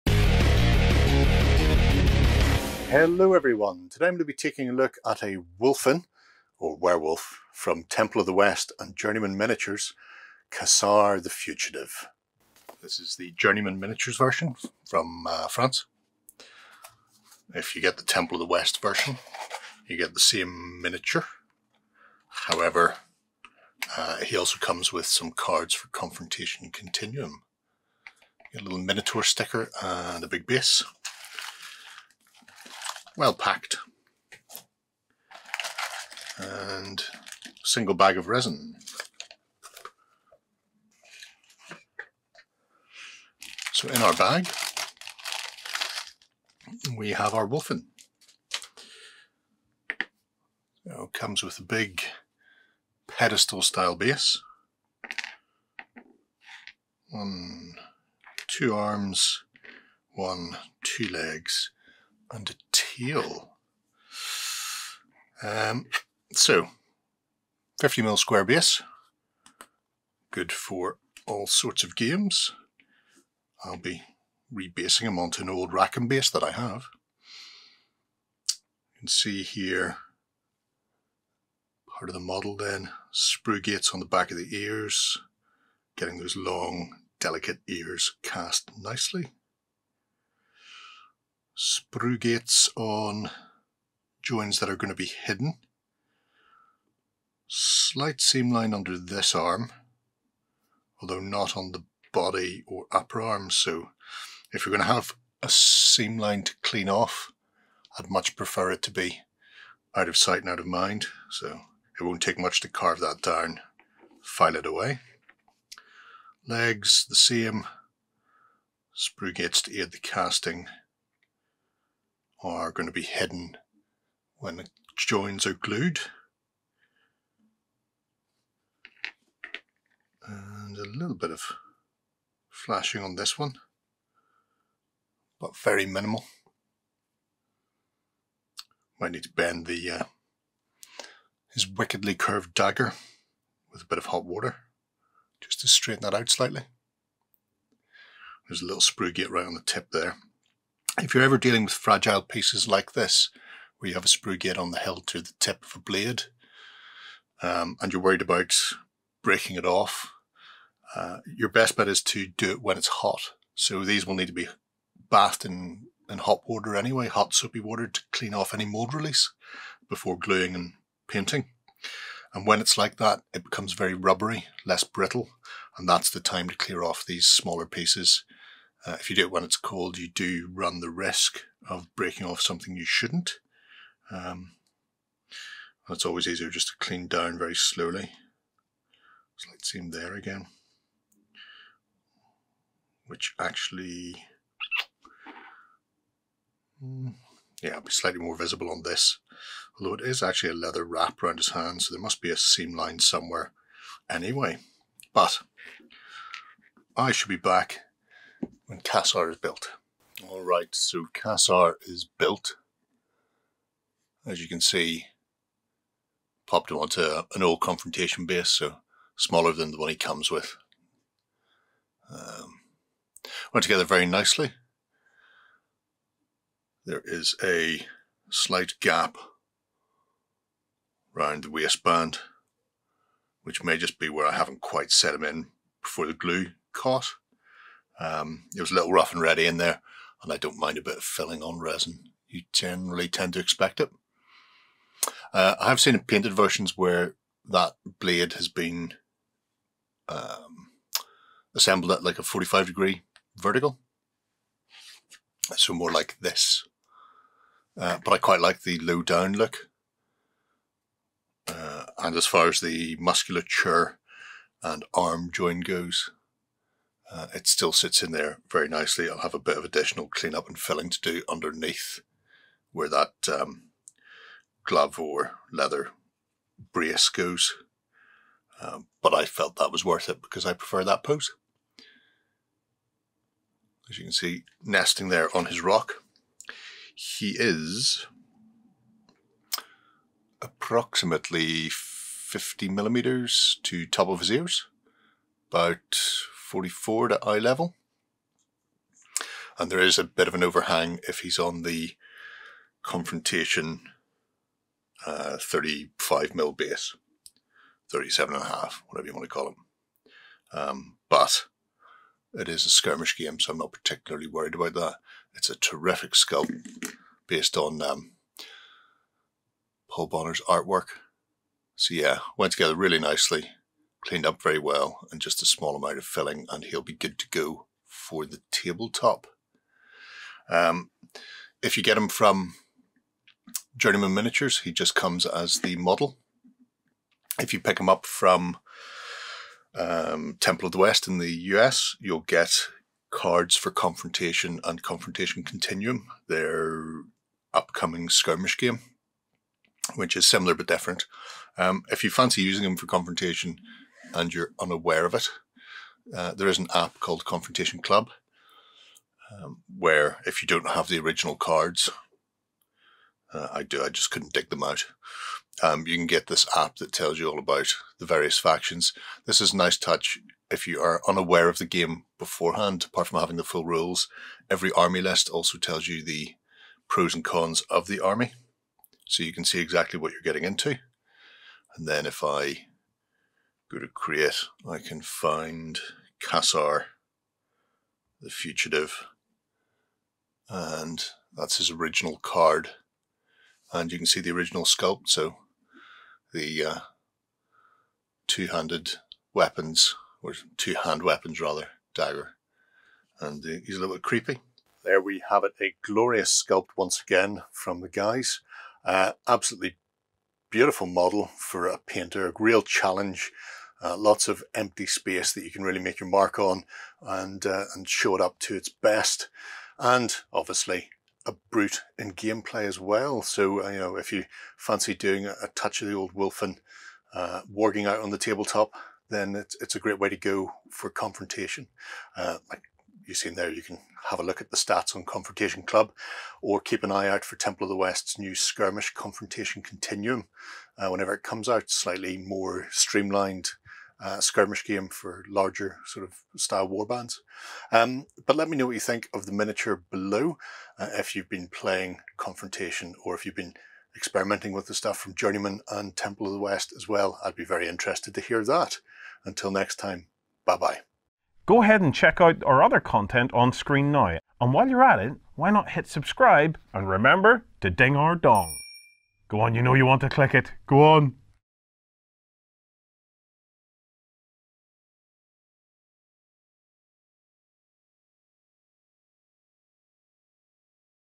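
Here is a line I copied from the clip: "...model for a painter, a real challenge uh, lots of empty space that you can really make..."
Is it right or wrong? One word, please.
right.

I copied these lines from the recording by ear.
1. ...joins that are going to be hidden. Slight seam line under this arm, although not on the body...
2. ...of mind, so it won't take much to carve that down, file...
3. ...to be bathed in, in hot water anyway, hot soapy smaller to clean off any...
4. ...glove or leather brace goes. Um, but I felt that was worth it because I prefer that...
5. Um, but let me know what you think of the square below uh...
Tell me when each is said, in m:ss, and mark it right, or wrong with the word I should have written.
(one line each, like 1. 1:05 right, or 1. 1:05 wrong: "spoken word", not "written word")
1. 1:34 right
2. 1:50 right
3. 2:44 wrong: "water", not "smaller"
4. 4:34 right
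5. 7:27 wrong: "miniature", not "square".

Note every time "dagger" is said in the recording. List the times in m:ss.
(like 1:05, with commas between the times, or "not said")
2:22, 6:41.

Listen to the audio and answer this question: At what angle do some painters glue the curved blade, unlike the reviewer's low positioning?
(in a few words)
45 degrees.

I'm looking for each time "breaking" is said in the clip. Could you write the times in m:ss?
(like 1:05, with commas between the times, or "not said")
2:39, 3:01.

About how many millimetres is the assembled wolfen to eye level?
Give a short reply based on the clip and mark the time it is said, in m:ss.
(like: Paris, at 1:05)
44, at 4:56.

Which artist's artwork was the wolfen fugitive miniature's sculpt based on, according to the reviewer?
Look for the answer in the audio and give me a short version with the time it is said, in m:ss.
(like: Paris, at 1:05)
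Paul Bonner, at 5:19.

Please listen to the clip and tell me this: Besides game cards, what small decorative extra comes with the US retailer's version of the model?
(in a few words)
Minotaur sticker.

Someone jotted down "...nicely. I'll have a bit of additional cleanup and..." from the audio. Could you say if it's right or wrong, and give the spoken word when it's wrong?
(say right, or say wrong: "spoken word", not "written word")
right.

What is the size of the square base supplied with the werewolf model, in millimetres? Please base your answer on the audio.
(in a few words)
50.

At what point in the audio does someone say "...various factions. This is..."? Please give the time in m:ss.
6:08.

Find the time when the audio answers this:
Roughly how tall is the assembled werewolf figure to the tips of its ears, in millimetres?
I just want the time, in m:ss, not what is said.
4:51.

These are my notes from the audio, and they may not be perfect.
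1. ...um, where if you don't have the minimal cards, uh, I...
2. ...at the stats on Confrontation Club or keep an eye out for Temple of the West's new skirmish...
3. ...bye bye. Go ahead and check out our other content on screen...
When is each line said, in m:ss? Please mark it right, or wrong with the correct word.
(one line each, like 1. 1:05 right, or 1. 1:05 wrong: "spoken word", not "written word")
1. 5:59 wrong: "original", not "minimal"
2. 7:14 right
3. 7:40 right.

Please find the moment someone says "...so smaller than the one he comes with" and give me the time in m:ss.
3:38.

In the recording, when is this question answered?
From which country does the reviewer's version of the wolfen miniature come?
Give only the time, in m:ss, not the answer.
0:15.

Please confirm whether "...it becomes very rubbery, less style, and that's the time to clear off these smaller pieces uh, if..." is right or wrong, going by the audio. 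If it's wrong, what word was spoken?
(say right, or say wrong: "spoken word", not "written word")
wrong: "brittle", not "style".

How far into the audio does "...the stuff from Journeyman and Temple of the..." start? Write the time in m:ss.
7:34.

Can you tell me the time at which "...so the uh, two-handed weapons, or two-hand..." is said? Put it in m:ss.
6:35.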